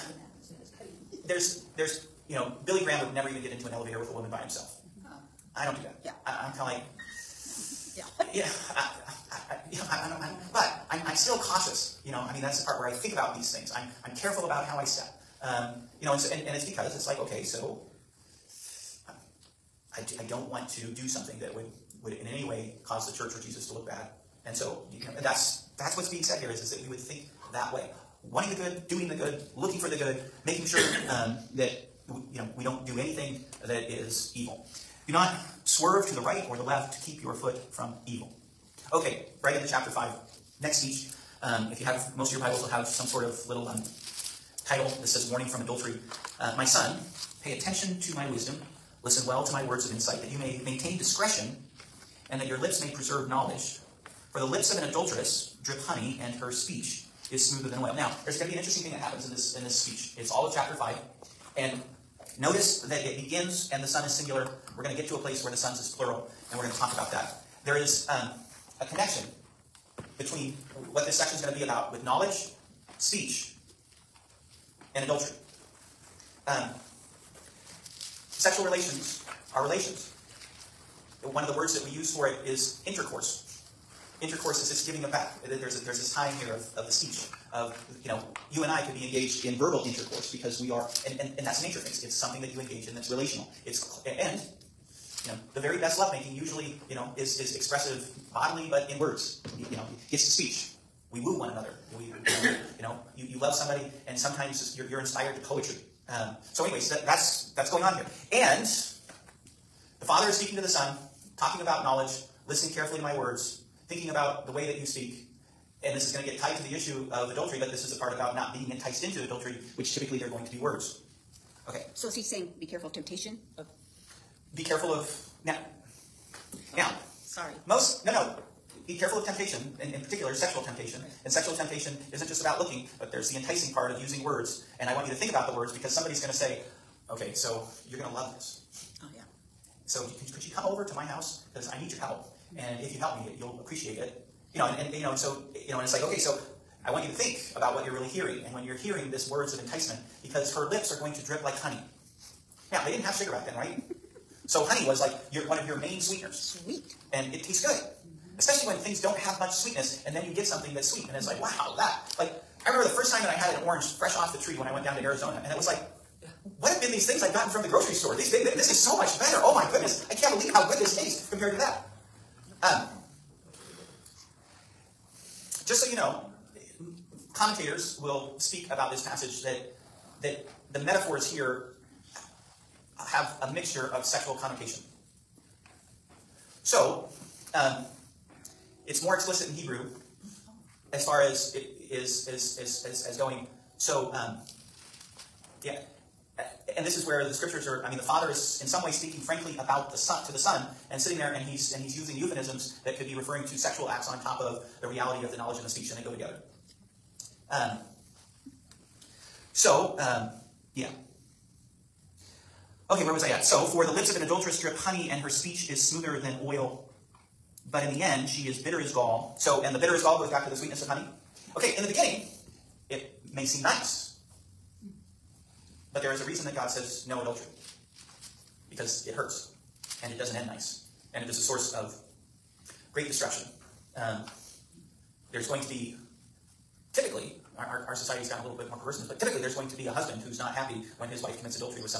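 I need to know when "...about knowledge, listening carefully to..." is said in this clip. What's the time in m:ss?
1:51.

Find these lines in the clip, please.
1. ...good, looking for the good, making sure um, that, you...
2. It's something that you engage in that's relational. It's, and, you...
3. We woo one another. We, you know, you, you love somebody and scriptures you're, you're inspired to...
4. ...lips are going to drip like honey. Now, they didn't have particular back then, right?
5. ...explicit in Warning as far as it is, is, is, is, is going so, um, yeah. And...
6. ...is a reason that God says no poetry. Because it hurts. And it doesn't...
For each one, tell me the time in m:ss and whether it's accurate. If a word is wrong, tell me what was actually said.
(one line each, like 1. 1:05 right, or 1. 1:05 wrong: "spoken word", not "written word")
1. 0:29 right
2. 1:32 right
3. 1:41 wrong: "sometimes", not "scriptures"
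4. 2:30 wrong: "sugar", not "particular"
5. 3:09 wrong: "Hebrew", not "Warning"
6. 3:46 wrong: "adultery", not "poetry".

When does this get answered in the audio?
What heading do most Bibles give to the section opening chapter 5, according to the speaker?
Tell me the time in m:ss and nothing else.
0:45.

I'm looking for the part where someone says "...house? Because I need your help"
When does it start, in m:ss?
2:21.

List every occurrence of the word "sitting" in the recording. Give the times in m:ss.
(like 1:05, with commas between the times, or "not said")
3:20.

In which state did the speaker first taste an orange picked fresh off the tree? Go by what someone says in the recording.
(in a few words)
Arizona.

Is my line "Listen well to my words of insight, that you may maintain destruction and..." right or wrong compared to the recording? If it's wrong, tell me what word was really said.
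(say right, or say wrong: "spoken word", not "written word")
wrong: "discretion", not "destruction".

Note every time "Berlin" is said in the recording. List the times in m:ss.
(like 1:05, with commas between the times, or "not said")
not said.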